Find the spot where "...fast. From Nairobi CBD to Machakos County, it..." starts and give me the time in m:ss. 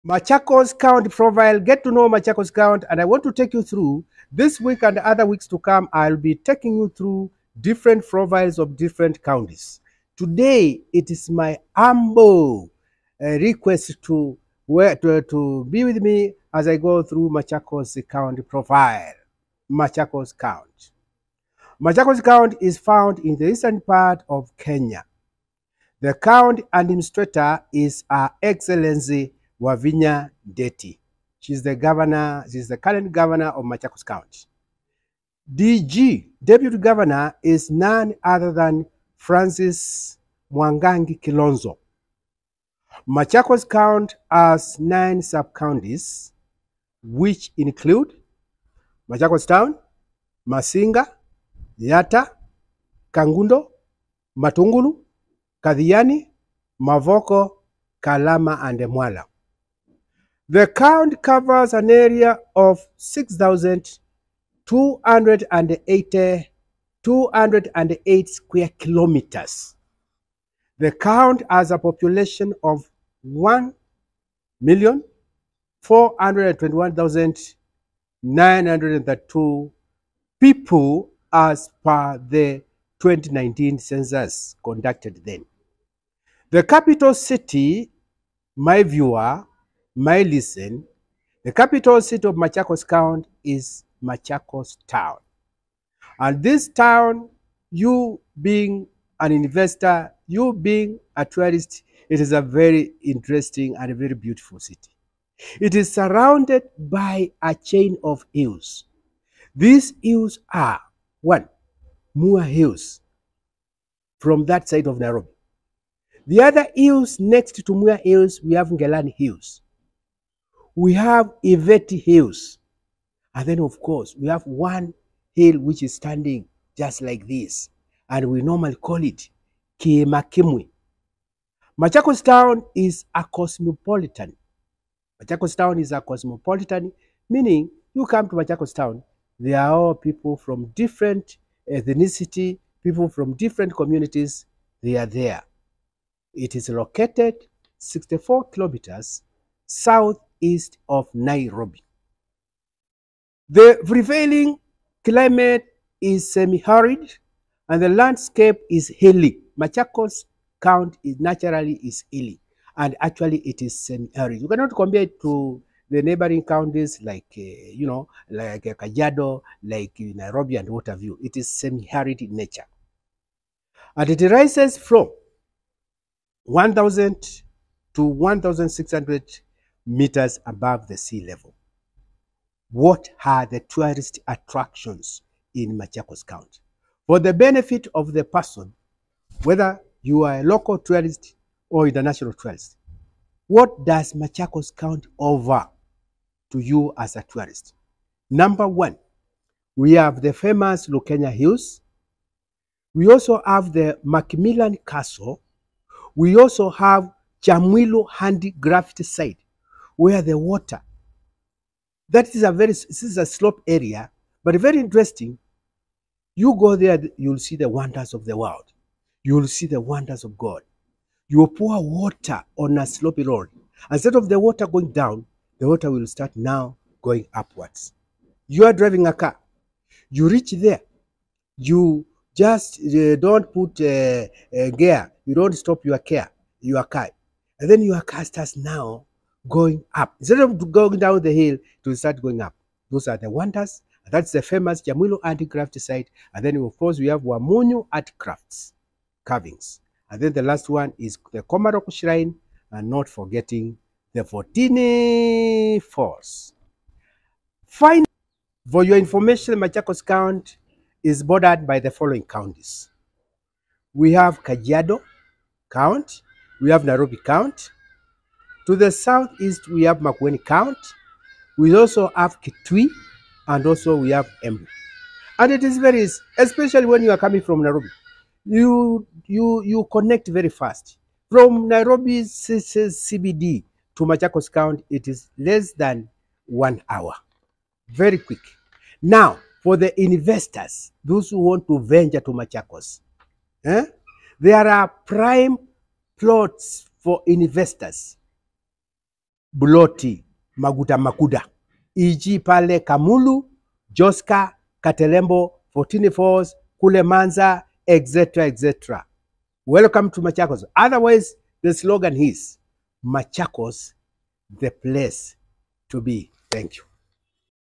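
4:40.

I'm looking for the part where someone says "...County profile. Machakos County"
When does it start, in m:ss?
0:18.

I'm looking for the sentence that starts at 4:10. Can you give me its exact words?
And then the last one is the Komarock Shrine, and not forgetting the Fourteen Falls.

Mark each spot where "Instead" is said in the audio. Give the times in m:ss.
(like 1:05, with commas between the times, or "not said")
3:43, 4:00.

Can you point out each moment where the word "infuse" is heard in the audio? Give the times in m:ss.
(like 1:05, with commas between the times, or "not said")
not said.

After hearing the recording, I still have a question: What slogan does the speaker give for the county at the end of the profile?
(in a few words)
Machakos, the place to be.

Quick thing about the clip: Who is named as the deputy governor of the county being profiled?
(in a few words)
Francis Mwangangi Kilonzo.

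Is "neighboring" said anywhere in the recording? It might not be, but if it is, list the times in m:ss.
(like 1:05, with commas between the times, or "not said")
2:46.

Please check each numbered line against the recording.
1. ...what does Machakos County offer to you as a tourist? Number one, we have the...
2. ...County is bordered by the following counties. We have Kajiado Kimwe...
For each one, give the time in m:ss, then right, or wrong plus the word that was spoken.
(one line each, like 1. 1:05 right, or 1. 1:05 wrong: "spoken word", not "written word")
1. 3:13 right
2. 4:20 wrong: "County", not "Kimwe".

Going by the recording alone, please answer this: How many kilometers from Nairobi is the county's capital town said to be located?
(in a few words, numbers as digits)
64.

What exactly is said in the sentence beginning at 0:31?
She's the governor, she's the current governor of Machakos County.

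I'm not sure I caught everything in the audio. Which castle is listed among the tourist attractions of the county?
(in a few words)
Macmillan Castle.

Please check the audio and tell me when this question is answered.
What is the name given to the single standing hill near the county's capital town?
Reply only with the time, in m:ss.
2:09.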